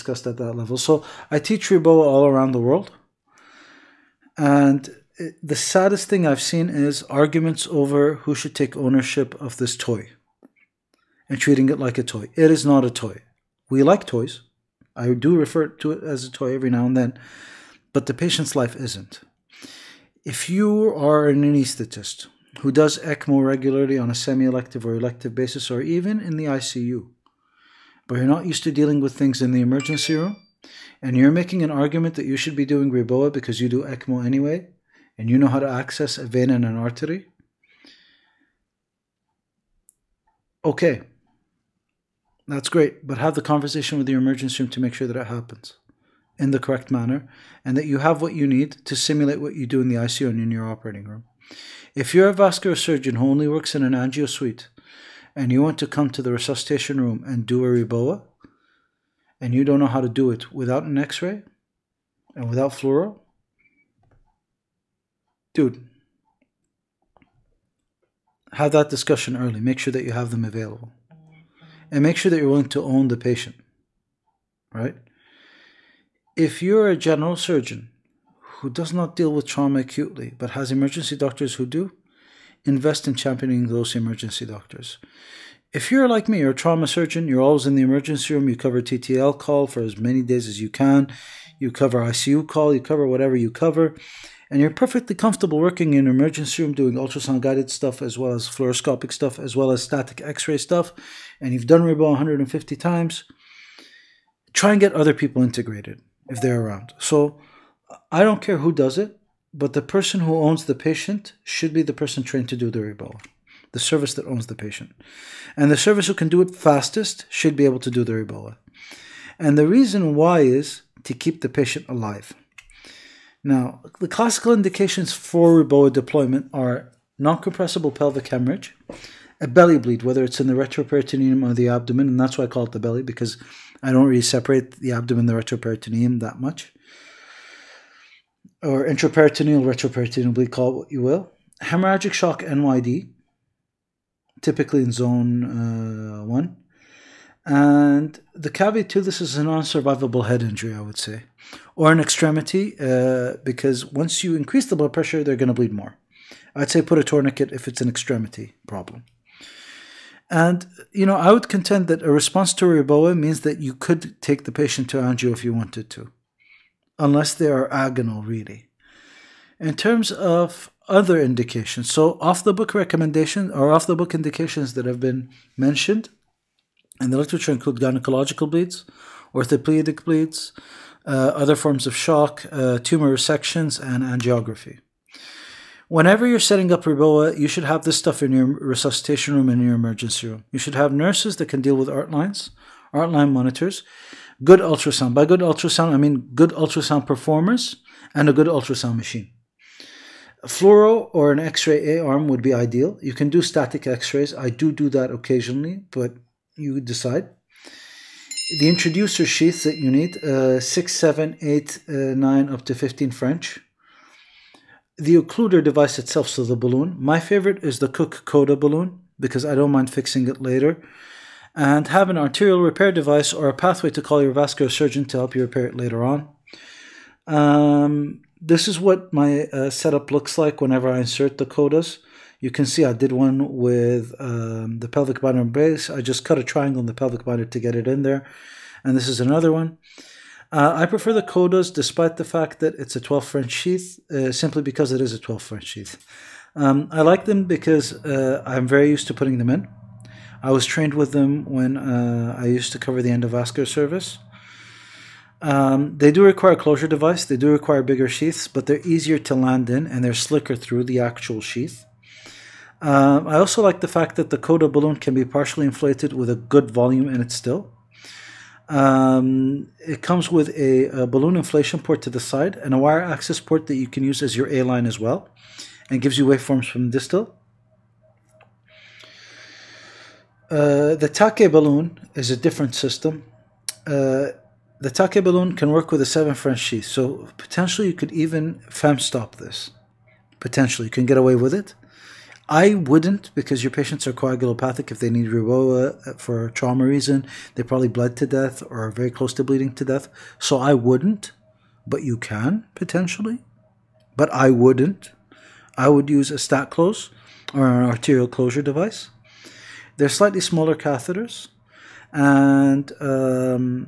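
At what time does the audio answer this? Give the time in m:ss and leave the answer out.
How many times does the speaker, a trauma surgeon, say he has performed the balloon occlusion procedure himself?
1:42.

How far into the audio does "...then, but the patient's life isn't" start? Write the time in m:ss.
0:16.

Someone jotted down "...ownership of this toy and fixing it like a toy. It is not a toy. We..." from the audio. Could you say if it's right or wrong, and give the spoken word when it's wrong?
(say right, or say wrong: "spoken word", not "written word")
wrong: "treating", not "fixing".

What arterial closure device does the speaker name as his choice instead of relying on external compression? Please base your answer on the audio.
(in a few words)
StarClose.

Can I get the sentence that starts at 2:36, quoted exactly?
I'd say put a tourniquet if it's an extremity problem.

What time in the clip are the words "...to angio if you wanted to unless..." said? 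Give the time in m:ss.
2:44.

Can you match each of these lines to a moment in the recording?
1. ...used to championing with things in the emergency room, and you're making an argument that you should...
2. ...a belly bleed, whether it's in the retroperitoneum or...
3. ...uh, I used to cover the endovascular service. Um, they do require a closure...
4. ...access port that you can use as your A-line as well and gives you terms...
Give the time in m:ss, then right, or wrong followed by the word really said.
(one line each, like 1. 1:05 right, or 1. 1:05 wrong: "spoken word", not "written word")
1. 0:28 wrong: "dealing", not "championing"
2. 2:09 right
3. 4:11 right
4. 4:33 wrong: "waveforms", not "terms".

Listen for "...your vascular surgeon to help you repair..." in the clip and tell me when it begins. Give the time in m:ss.
3:44.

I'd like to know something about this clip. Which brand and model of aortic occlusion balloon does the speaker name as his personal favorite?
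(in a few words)
Cook Coda.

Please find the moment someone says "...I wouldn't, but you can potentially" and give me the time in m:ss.
5:00.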